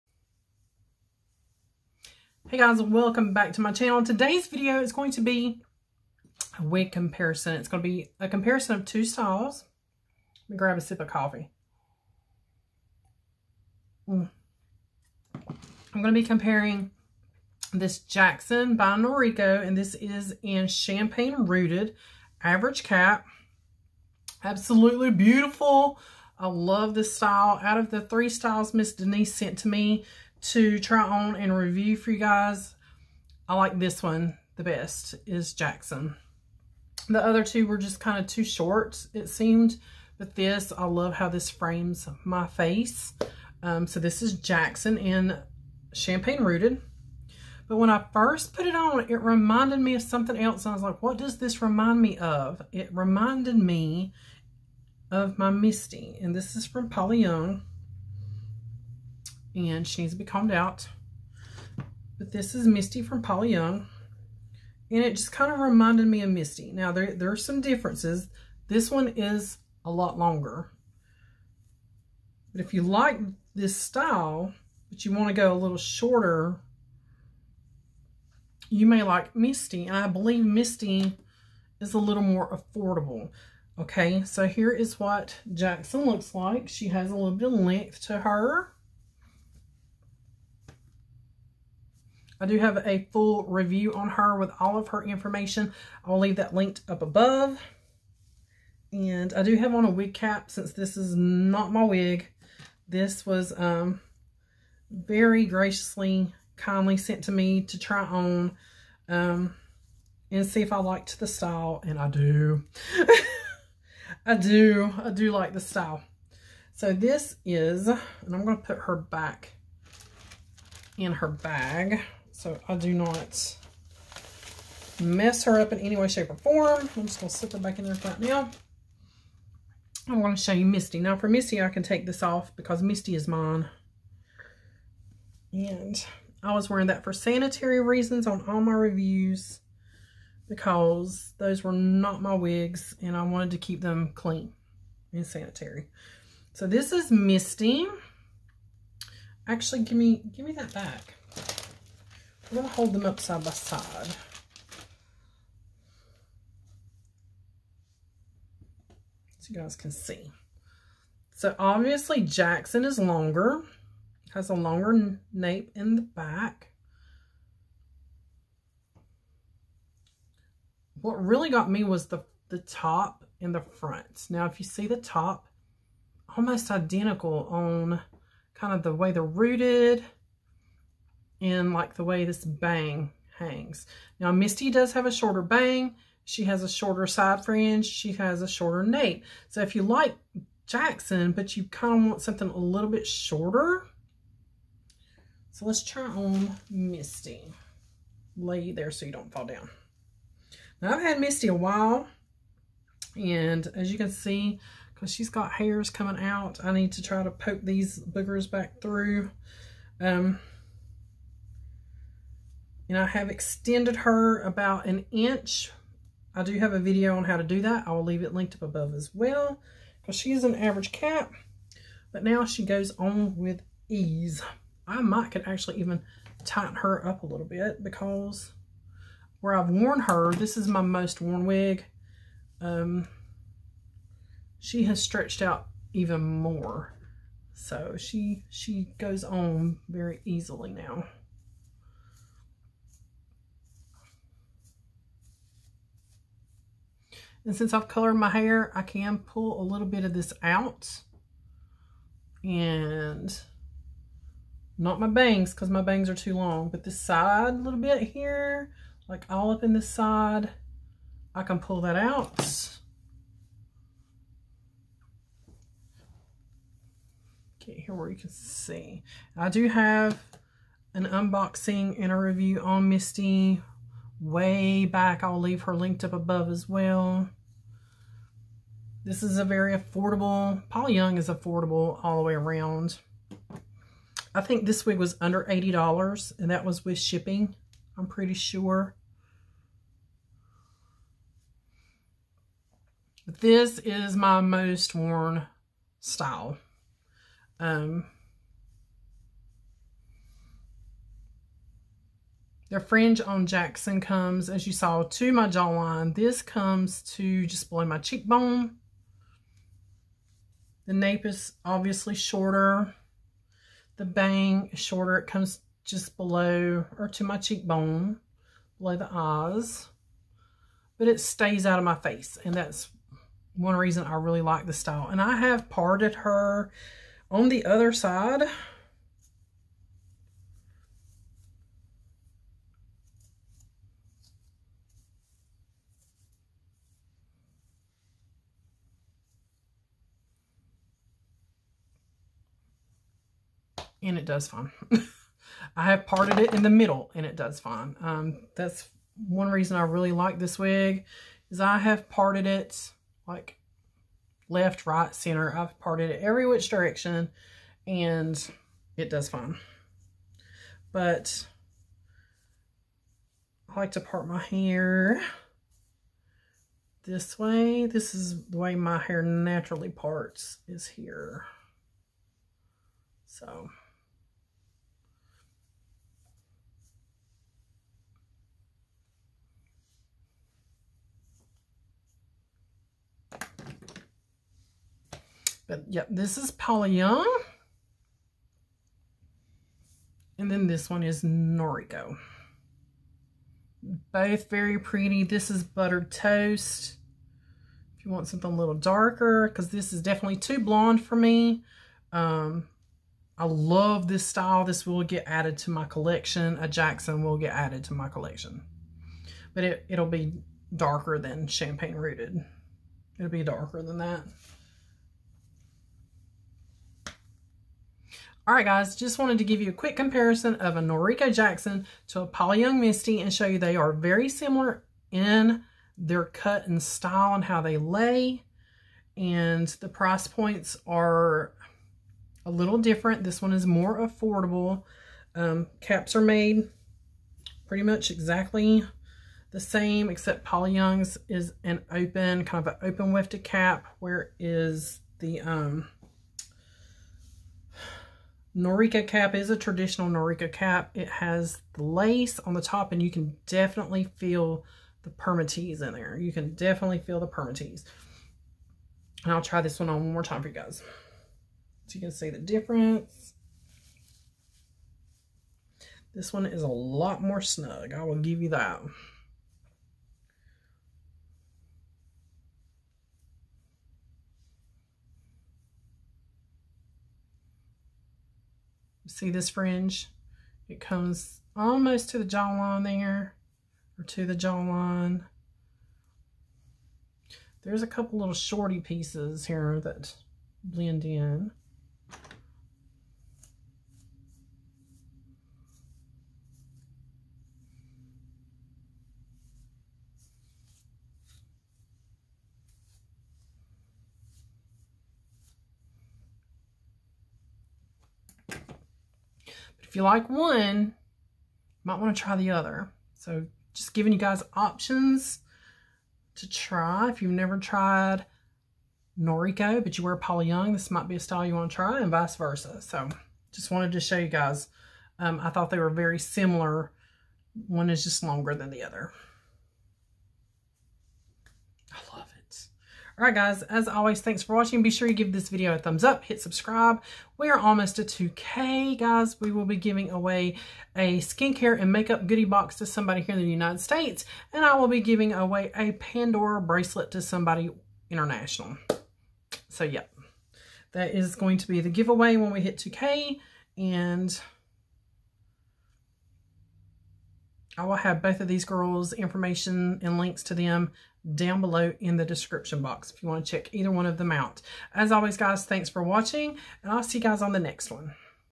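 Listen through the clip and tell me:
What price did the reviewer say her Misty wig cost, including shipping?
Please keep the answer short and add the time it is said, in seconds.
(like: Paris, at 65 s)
under $80, at 285 s.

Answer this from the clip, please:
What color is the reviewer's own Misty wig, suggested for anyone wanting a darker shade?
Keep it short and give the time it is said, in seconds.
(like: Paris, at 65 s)
Buttered Toast, at 395 s.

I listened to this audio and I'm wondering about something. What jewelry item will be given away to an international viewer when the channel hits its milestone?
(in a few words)
Pandora bracelet.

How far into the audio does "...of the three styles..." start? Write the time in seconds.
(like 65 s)
27 s.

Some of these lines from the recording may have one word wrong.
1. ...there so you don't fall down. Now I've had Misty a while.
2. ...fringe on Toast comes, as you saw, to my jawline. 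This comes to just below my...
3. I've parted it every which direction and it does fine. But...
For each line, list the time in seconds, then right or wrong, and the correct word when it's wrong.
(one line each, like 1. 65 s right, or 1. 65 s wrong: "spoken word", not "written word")
1. 198 s right
2. 302 s wrong: "Jackson", not "Toast"
3. 355 s right.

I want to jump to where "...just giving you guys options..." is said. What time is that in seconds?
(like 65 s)
513 s.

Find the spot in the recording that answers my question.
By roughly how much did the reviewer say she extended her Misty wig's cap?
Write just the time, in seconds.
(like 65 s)
214 s.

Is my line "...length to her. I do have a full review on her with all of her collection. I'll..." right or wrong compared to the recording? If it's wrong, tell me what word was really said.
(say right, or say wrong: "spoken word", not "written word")
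wrong: "information", not "collection".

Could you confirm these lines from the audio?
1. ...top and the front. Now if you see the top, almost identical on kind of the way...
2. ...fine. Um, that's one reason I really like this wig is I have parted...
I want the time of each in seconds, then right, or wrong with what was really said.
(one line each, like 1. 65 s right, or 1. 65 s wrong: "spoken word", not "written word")
1. 172 s right
2. 347 s right.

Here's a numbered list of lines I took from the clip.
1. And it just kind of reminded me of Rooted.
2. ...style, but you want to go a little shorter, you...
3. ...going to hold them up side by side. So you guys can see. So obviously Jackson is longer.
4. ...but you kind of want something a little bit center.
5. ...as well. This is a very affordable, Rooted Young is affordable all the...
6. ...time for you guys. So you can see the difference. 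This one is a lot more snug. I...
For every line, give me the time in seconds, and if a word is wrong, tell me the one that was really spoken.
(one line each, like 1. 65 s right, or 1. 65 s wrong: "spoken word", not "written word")
1. 64 s wrong: "Misty", not "Rooted"
2. 73 s right
3. 152 s right
4. 191 s wrong: "shorter", not "center"
5. 276 s wrong: "Paula", not "Rooted"
6. 460 s right.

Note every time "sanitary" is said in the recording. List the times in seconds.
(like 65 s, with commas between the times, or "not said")
137 s, 145 s.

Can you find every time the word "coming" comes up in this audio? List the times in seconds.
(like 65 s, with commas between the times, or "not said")
205 s.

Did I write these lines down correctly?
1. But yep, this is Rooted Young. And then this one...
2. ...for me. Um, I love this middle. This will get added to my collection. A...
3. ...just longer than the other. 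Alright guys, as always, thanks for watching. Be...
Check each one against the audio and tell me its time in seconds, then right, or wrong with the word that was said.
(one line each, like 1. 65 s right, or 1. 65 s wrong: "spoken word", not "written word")
1. 385 s wrong: "Paula", not "Rooted"
2. 401 s wrong: "style", not "middle"
3. 528 s right.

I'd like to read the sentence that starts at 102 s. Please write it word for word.
This was um, very graciously, kindly sent to me to try on um, and see if I liked the style.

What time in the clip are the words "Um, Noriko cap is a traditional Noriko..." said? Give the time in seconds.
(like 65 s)
445 s.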